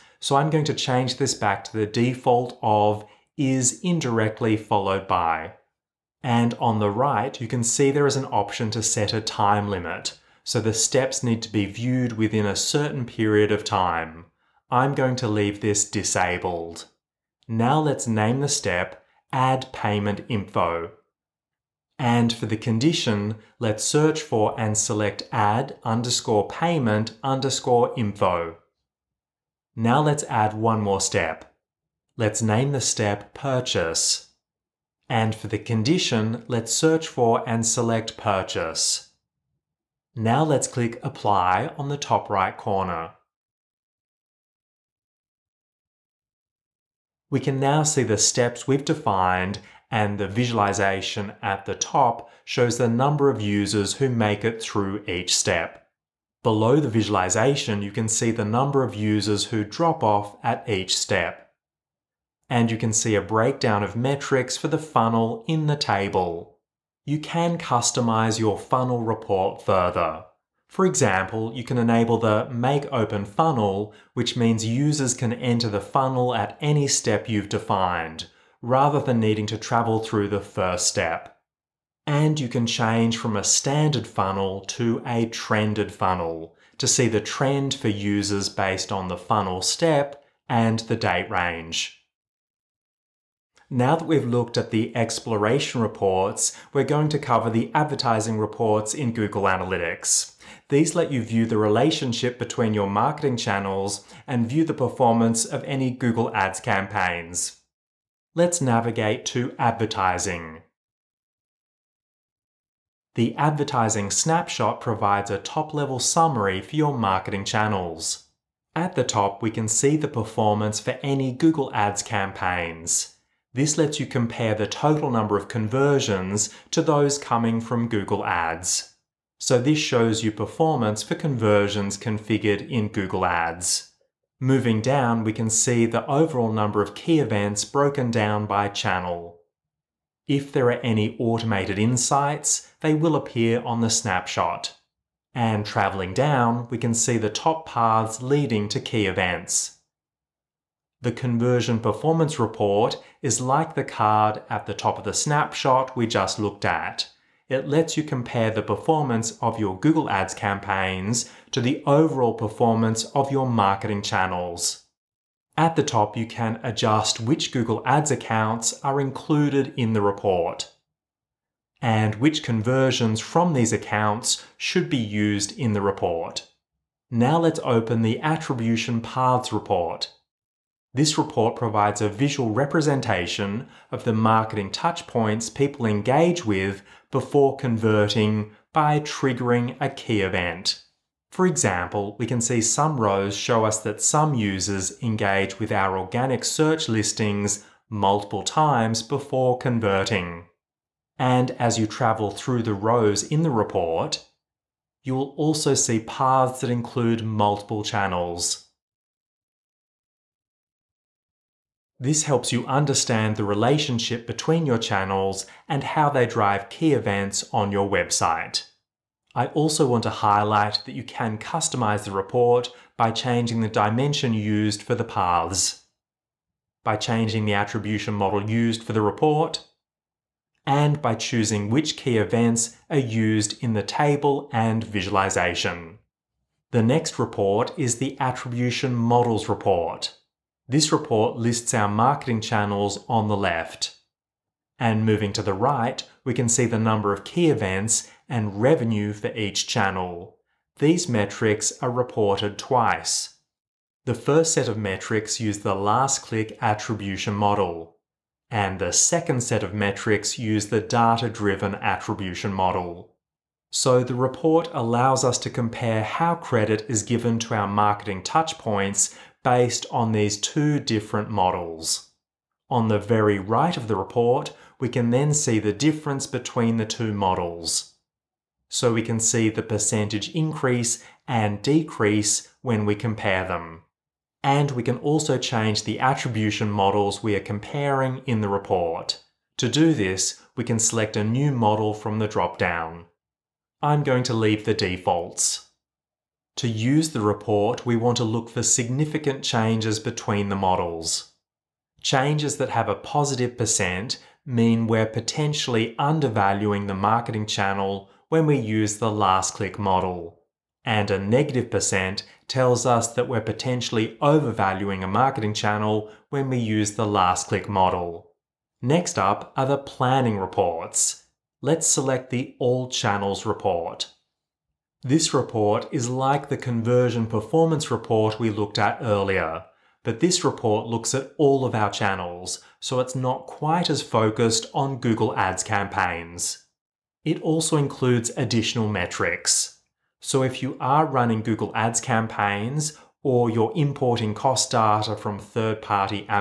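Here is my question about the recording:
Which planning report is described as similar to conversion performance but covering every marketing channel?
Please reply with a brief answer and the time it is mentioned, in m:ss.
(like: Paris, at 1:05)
All Channels, at 5:22.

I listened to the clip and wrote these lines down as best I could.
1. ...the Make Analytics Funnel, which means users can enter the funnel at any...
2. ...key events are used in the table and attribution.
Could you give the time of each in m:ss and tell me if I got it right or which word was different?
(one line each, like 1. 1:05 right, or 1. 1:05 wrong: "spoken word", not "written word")
1. 1:12 wrong: "Open", not "Analytics"
2. 3:51 wrong: "visualization", not "attribution".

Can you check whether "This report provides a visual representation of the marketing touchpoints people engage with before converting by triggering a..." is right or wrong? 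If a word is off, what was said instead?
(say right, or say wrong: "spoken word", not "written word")
right.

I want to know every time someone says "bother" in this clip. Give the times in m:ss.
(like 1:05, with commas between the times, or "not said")
not said.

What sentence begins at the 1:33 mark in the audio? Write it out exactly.
Now that we've looked at the exploration reports, we're going to cover the advertising reports in Google Analytics.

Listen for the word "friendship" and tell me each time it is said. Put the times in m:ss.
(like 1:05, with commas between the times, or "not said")
not said.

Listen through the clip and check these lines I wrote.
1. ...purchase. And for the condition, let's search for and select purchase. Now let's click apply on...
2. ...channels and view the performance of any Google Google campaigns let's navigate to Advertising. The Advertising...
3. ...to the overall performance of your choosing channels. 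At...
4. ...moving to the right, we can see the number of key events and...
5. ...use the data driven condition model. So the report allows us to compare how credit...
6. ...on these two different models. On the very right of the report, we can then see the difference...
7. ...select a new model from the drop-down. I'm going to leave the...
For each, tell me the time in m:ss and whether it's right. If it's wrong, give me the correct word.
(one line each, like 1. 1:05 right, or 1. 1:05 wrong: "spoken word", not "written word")
1. 0:33 right
2. 1:43 wrong: "Ads", not "Google"
3. 2:41 wrong: "marketing", not "choosing"
4. 4:05 right
5. 4:20 wrong: "attribution", not "condition"
6. 4:29 right
7. 4:50 right.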